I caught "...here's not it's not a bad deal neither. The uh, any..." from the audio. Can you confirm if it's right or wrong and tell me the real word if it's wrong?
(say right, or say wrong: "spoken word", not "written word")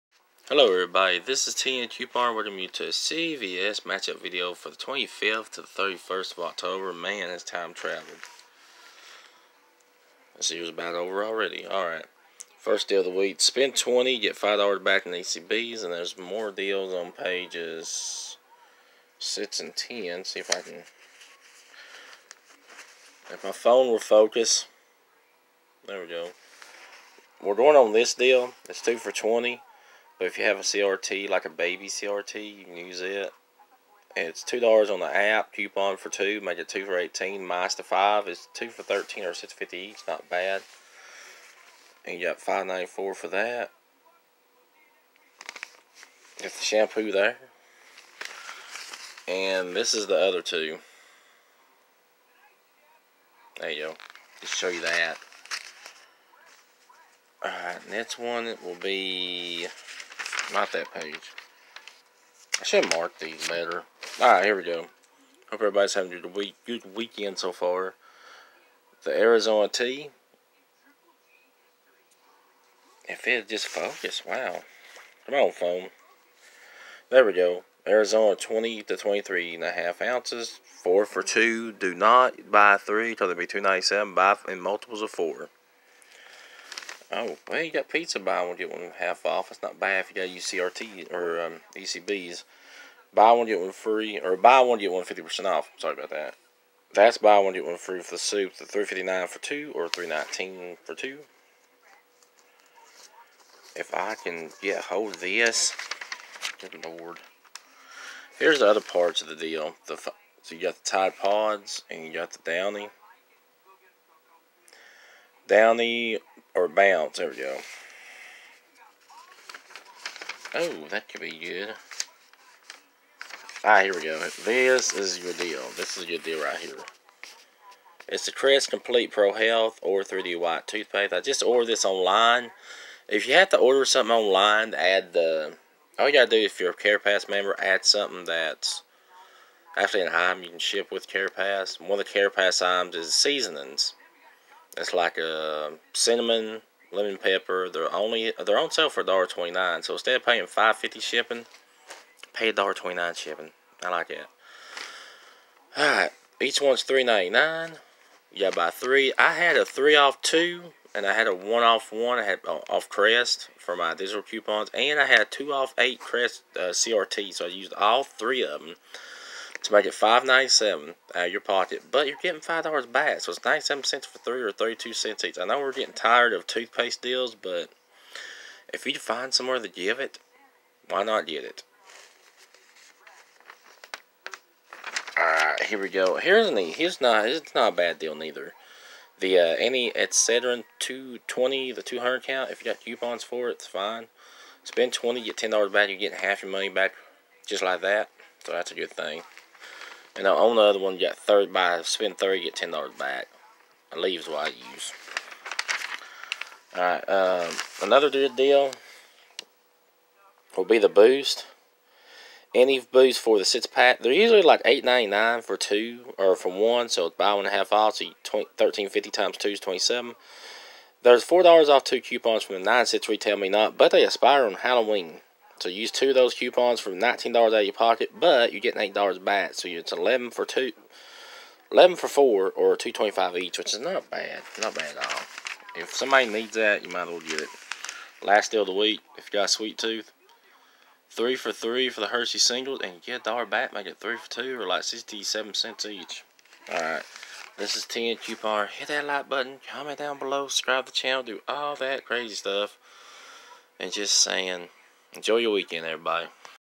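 right.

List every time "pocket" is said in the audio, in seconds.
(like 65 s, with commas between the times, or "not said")
171 s, 227 s.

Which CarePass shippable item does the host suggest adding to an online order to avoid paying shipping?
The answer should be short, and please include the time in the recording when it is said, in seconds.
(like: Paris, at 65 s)
seasonings, at 143 s.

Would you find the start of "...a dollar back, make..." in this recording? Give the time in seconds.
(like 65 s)
243 s.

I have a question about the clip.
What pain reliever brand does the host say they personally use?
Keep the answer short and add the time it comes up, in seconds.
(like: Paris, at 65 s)
Aleve, at 203 s.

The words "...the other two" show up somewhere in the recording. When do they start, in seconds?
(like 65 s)
50 s.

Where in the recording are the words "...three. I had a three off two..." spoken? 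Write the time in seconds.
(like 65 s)
158 s.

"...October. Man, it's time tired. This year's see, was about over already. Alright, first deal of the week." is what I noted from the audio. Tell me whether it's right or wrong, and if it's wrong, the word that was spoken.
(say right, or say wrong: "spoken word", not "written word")
wrong: "traveled", not "tired".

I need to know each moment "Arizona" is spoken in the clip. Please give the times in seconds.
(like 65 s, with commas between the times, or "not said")
69 s, 77 s.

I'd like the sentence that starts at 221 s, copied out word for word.
There's four dollars off two coupons from the nine six RetailMeNot, but they expire on Halloween.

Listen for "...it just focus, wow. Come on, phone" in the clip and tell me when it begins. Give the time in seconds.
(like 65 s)
73 s.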